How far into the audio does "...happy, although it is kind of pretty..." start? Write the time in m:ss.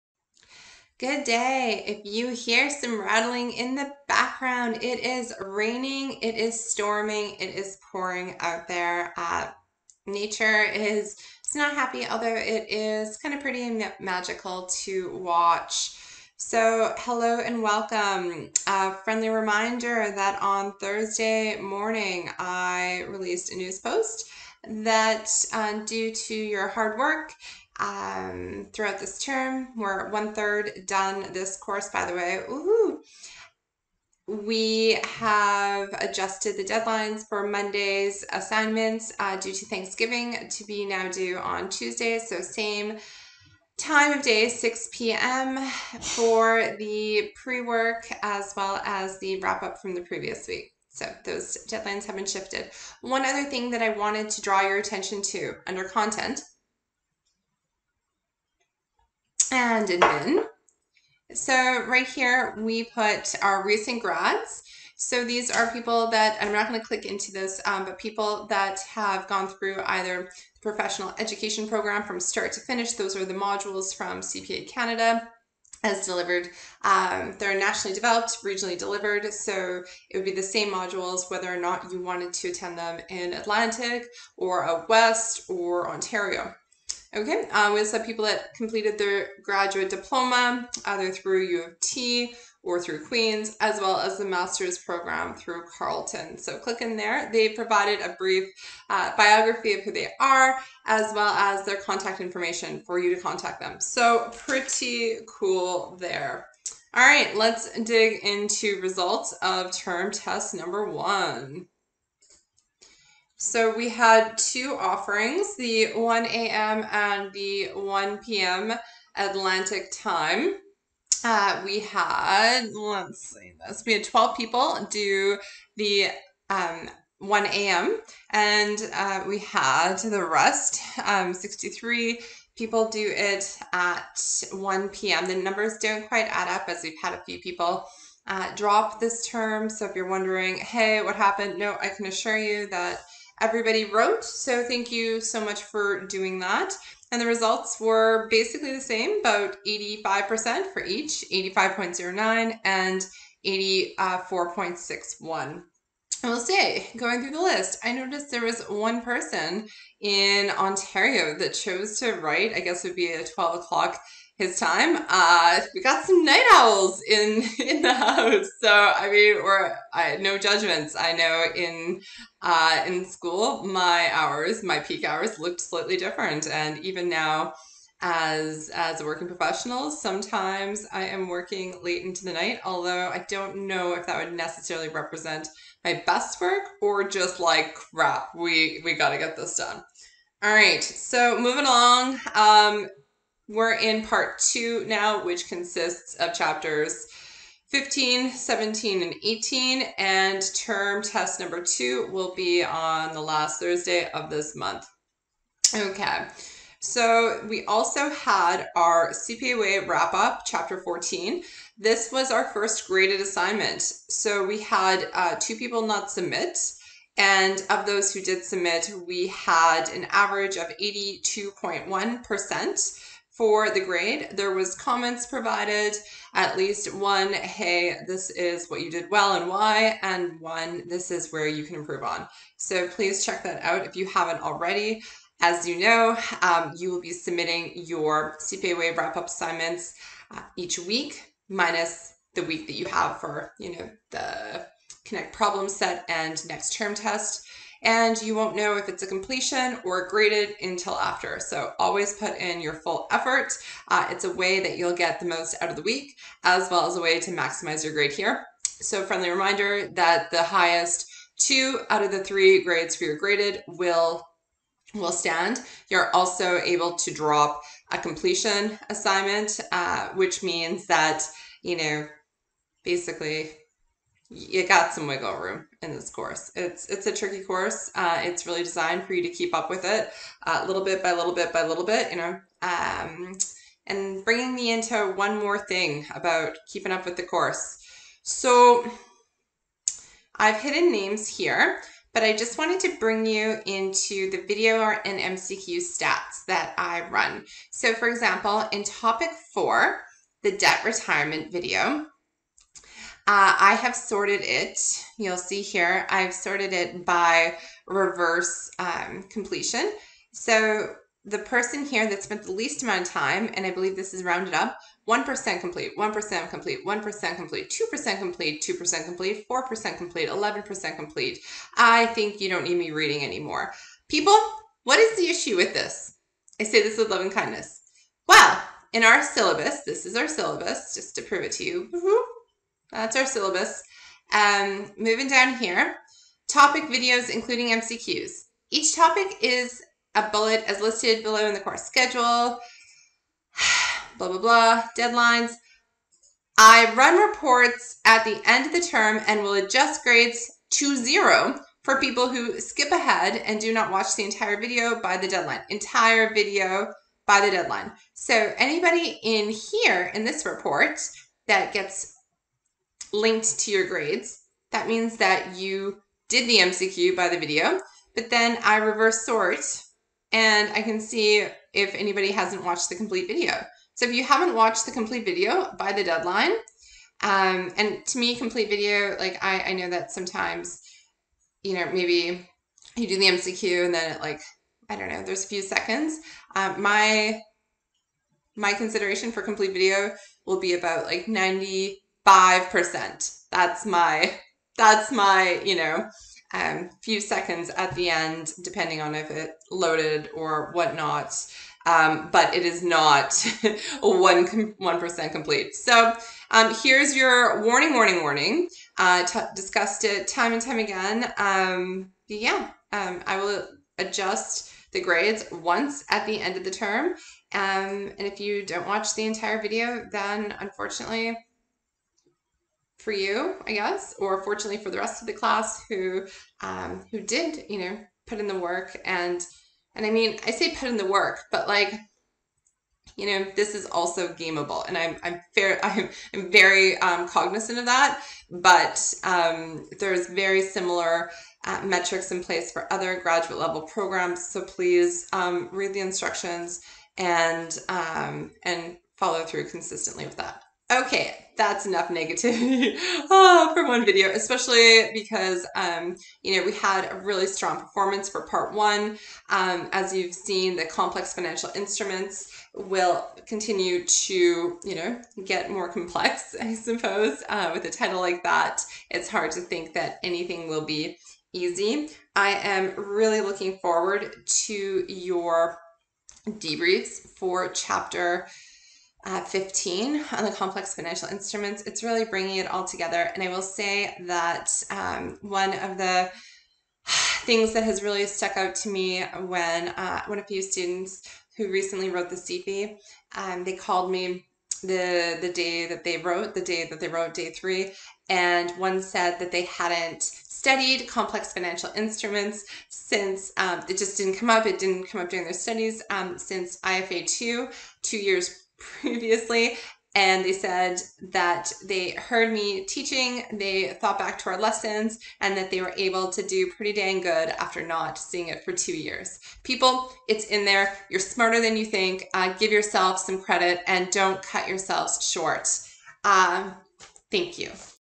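0:11.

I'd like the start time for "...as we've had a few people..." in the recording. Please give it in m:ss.
2:16.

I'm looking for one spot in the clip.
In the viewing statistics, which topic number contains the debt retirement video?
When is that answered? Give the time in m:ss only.
4:59.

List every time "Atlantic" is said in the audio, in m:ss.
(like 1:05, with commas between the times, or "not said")
1:23, 1:59.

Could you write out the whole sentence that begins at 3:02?
Although I don't know if that would necessarily represent my best work or just like crap.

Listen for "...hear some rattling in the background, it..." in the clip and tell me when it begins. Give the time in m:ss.
0:02.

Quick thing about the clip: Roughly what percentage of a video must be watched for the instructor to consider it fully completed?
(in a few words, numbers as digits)
95%.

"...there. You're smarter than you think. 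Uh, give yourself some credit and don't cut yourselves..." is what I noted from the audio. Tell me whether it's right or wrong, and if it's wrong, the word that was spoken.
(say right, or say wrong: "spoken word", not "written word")
right.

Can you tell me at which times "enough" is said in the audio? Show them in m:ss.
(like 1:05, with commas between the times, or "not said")
7:31.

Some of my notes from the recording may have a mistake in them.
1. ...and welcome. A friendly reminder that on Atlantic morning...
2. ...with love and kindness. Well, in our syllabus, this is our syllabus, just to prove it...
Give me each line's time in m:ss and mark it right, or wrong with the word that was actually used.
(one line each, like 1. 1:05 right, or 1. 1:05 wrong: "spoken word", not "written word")
1. 0:17 wrong: "Thursday", not "Atlantic"
2. 5:26 right.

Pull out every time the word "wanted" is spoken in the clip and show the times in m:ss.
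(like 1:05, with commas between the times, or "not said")
0:53, 1:21, 4:52.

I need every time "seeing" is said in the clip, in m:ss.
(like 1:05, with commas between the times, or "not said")
8:38.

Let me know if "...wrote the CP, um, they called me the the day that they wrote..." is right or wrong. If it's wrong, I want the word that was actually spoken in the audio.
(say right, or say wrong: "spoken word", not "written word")
right.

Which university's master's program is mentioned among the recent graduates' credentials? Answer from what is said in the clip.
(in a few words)
Carleton.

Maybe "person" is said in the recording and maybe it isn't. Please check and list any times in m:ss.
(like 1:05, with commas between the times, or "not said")
2:39, 5:11.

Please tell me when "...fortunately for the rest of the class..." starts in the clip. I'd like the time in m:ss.
7:04.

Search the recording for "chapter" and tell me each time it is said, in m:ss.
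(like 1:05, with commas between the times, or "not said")
3:16, 3:30, 7:57.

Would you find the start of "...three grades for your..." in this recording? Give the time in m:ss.
4:22.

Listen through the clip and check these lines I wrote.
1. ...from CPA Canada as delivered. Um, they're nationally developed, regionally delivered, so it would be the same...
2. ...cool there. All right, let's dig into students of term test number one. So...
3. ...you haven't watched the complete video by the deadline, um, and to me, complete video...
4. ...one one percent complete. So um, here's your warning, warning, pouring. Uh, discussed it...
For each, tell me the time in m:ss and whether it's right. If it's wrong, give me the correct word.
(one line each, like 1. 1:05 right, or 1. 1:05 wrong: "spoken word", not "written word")
1. 1:13 right
2. 1:45 wrong: "results", not "students"
3. 6:14 right
4. 6:44 wrong: "warning", not "pouring".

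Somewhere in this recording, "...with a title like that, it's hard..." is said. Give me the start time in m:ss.
7:47.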